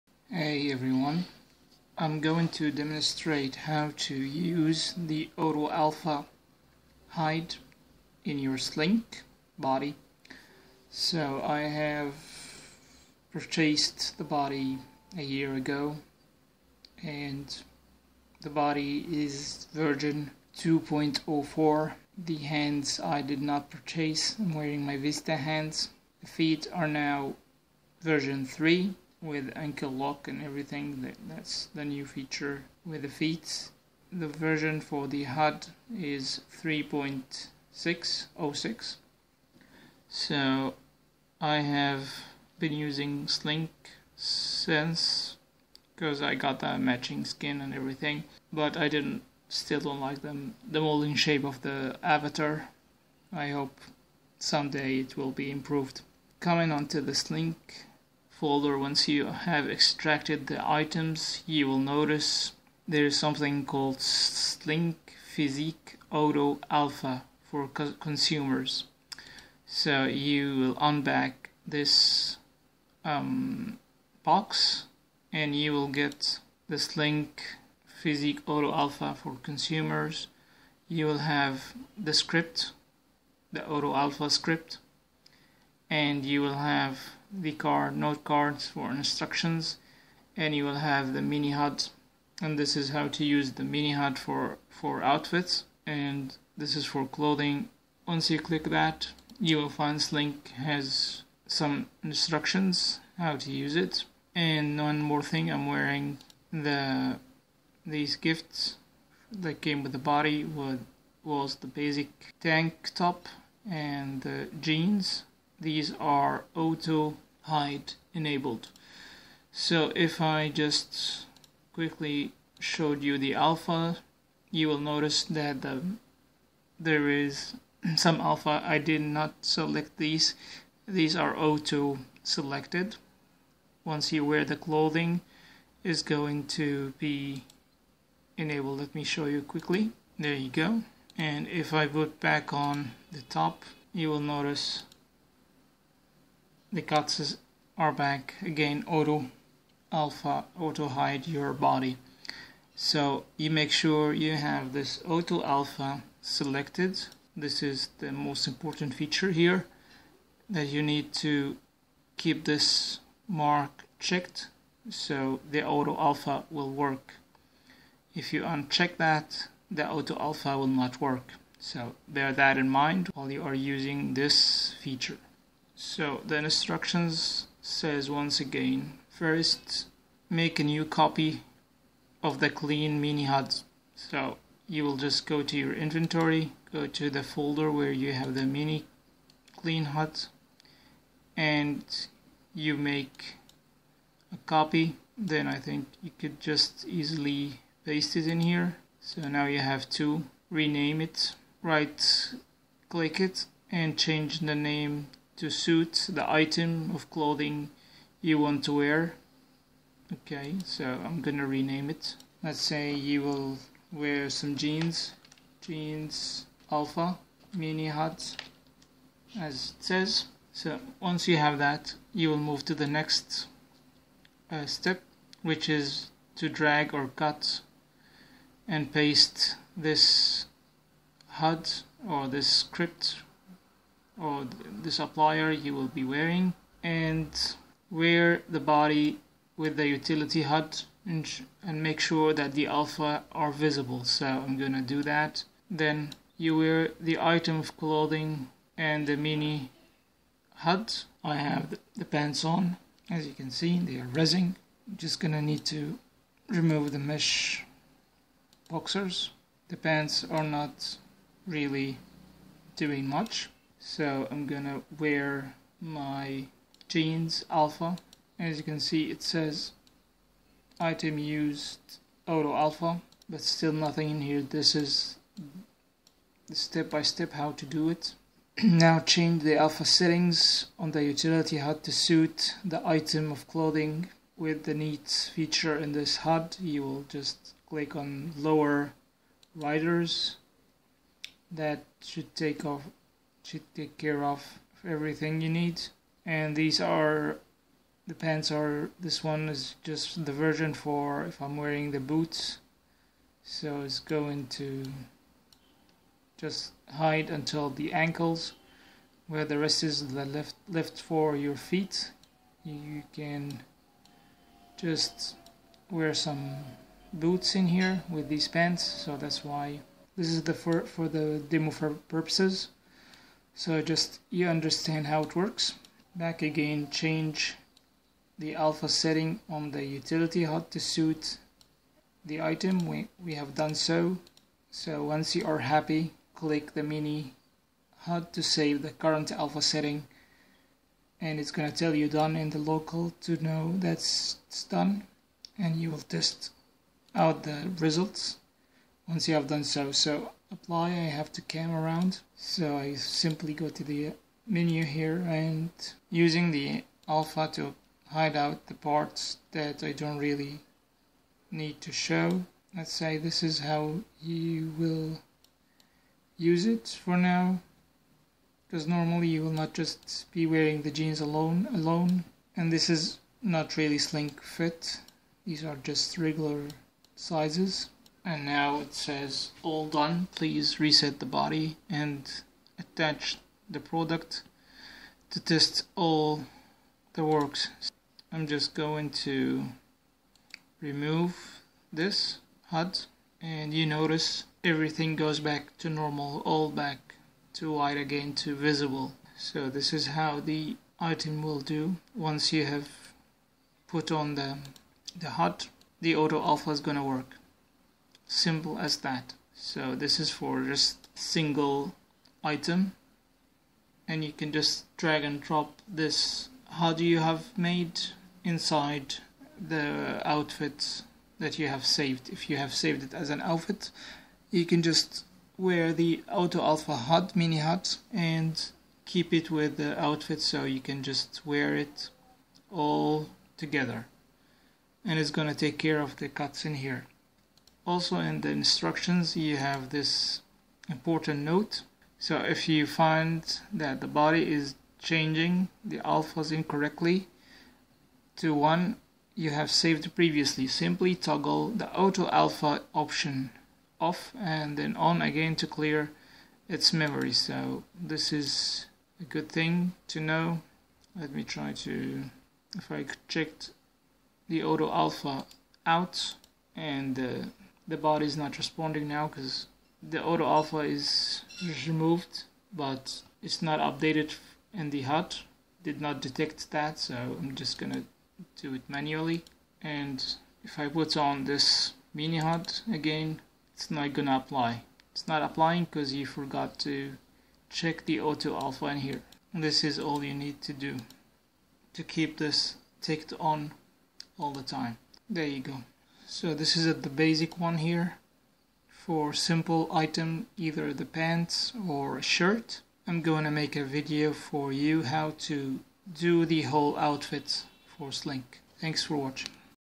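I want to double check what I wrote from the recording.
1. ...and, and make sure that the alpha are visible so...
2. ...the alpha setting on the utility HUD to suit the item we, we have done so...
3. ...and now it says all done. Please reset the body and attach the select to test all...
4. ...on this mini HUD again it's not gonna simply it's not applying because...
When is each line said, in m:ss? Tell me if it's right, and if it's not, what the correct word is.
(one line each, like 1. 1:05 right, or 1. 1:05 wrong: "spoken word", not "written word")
1. 4:01 right
2. 5:28 right
3. 6:18 wrong: "product", not "select"
4. 8:01 wrong: "apply", not "simply".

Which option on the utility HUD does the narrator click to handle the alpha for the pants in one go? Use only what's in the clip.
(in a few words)
lower riders.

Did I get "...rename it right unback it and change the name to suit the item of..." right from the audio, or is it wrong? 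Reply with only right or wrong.
wrong.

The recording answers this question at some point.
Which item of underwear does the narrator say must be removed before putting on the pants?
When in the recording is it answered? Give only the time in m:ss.
4:16.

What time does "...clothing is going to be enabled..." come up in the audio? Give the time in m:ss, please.
2:14.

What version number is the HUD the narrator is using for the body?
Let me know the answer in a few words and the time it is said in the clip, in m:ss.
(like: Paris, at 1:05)
3.606, at 0:36.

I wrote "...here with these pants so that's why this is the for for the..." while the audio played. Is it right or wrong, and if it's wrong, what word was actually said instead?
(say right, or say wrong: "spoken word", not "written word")
right.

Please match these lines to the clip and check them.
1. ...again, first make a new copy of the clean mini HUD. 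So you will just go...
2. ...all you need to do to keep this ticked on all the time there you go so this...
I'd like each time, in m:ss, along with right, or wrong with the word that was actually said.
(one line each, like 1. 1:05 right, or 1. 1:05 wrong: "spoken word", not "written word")
1. 2:58 right
2. 8:09 right.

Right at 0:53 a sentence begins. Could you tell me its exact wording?
I hope someday it will be improved.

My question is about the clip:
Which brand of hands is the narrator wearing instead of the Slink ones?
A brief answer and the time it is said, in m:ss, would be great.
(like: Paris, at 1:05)
Vista, at 0:24.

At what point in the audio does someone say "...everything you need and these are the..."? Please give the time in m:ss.
4:54.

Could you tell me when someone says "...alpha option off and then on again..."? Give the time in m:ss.
7:32.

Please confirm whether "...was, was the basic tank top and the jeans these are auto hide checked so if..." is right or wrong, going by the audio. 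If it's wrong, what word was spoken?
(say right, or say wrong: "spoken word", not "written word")
wrong: "enabled", not "checked".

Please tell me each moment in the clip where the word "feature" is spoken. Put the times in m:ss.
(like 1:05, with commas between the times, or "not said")
0:32, 2:38, 2:54, 4:45.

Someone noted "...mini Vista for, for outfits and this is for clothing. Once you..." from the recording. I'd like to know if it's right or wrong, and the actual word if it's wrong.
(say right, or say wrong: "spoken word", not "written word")
wrong: "HUD", not "Vista".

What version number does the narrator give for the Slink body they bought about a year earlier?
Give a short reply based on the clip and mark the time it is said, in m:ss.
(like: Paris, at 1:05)
2.04, at 0:19.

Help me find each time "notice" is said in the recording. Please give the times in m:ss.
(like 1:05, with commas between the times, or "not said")
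1:01, 2:04, 2:24, 6:33.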